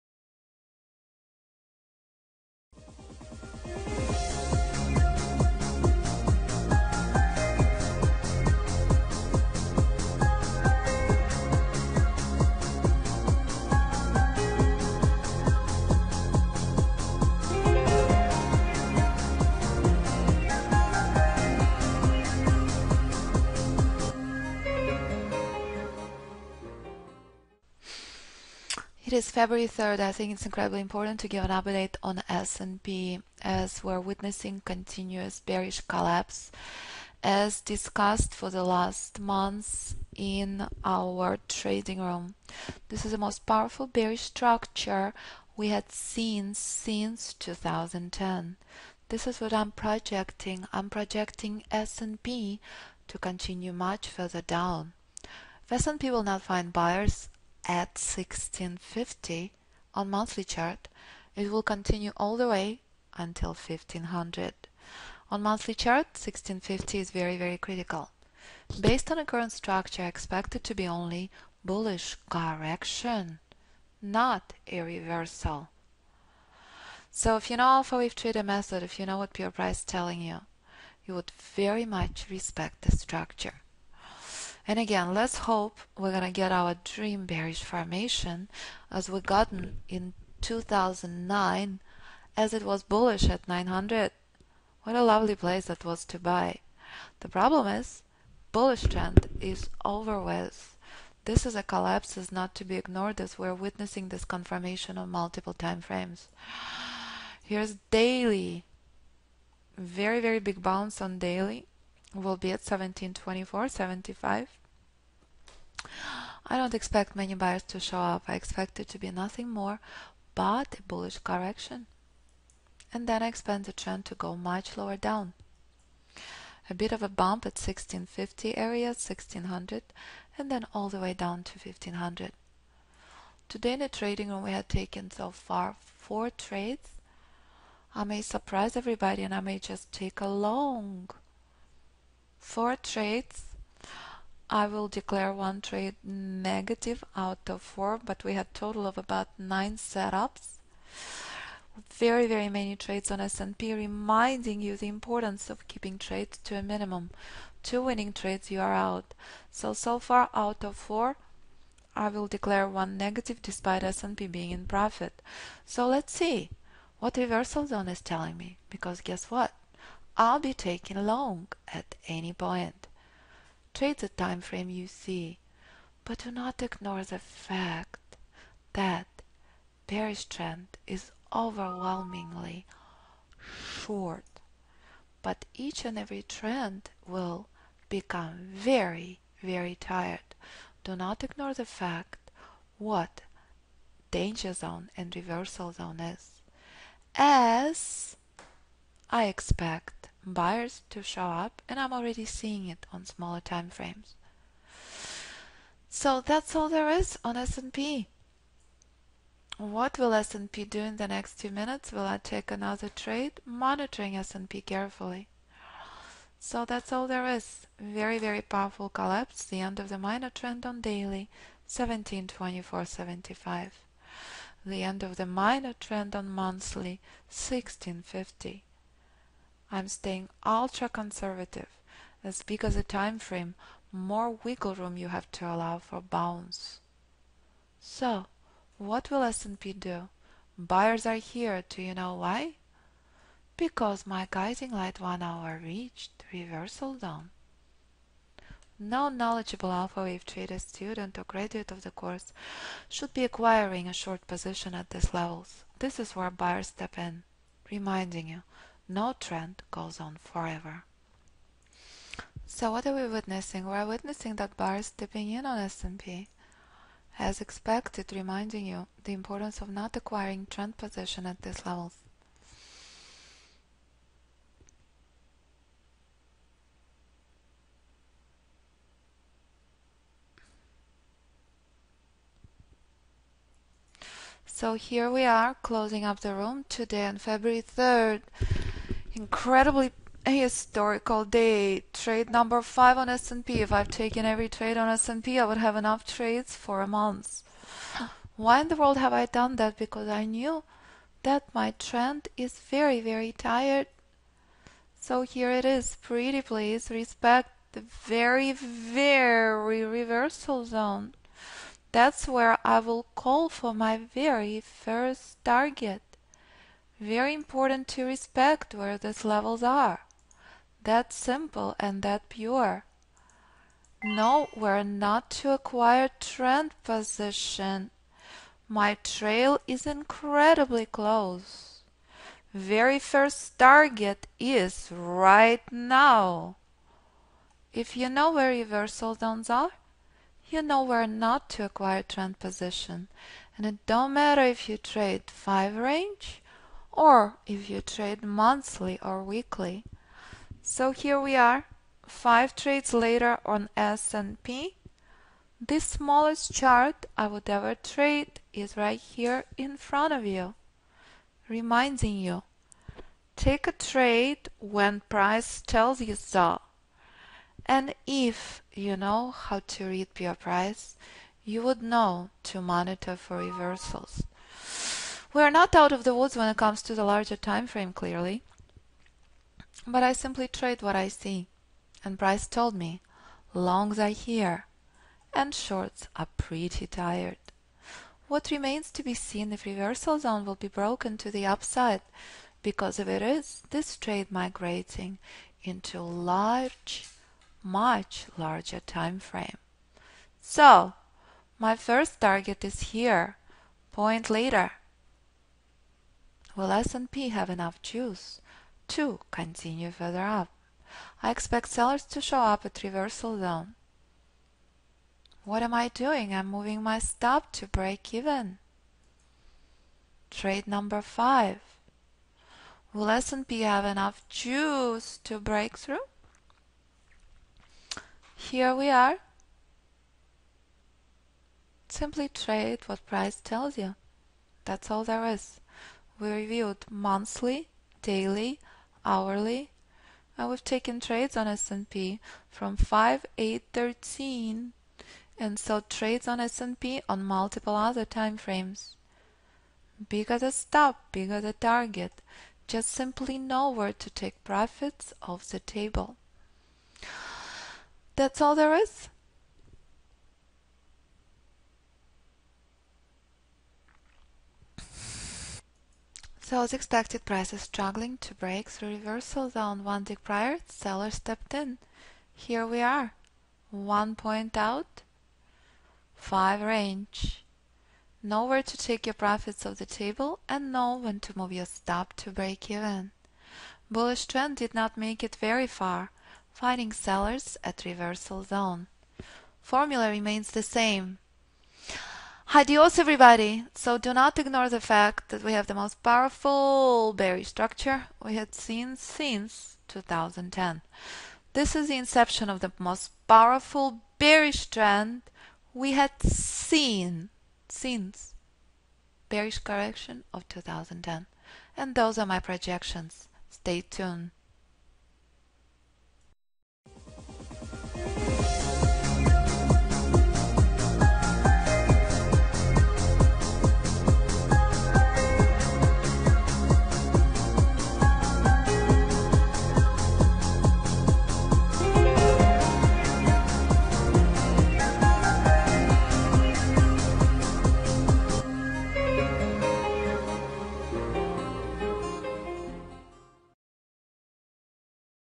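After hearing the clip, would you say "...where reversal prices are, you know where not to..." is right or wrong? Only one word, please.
wrong.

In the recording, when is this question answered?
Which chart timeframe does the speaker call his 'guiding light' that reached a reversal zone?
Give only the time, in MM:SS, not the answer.
04:04.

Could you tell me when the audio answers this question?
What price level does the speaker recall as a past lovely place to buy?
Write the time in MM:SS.
01:33.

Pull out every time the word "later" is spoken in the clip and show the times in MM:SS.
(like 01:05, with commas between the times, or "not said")
05:52, 06:44.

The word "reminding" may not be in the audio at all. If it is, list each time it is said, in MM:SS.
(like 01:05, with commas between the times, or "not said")
02:33, 04:17, 04:28, 06:01.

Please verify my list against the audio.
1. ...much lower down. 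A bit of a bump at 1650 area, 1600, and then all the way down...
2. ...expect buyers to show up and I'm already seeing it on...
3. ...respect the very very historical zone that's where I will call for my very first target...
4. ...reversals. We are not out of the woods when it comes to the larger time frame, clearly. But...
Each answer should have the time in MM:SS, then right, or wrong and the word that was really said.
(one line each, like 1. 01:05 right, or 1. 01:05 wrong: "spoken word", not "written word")
1. 02:04 right
2. 03:19 right
3. 05:06 wrong: "reversal", not "historical"
4. 06:13 right.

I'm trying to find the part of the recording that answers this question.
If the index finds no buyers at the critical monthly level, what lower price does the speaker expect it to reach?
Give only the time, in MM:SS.
01:02.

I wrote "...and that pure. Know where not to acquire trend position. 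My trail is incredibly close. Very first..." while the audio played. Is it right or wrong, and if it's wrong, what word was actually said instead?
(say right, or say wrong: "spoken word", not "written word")
right.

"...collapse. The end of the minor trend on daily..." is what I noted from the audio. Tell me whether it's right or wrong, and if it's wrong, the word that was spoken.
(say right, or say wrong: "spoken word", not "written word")
right.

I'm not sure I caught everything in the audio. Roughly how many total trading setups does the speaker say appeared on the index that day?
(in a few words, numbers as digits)
about nine.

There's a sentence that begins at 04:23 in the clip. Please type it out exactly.
We're witnessing that bars stepping in on S&P.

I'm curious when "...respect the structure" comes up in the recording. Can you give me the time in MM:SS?
01:22.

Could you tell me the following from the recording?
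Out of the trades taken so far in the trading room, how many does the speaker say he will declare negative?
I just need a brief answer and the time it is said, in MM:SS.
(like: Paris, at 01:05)
1, at 02:25.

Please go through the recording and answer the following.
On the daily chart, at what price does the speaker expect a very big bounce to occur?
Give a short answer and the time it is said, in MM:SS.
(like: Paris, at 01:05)
1724.75, at 01:52.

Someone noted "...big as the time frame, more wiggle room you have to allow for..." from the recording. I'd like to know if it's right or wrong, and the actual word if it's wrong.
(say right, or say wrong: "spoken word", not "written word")
right.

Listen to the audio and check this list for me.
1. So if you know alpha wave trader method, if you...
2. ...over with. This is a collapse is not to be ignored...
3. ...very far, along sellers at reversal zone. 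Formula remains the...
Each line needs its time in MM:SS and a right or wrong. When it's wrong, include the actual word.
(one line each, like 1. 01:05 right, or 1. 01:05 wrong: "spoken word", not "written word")
1. 01:17 right
2. 01:39 right
3. 08:05 wrong: "finding", not "along".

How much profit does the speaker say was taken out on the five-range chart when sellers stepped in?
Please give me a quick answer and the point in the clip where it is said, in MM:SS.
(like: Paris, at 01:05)
1 point, at 07:53.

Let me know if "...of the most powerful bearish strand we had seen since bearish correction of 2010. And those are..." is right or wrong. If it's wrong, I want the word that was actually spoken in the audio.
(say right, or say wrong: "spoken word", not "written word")
right.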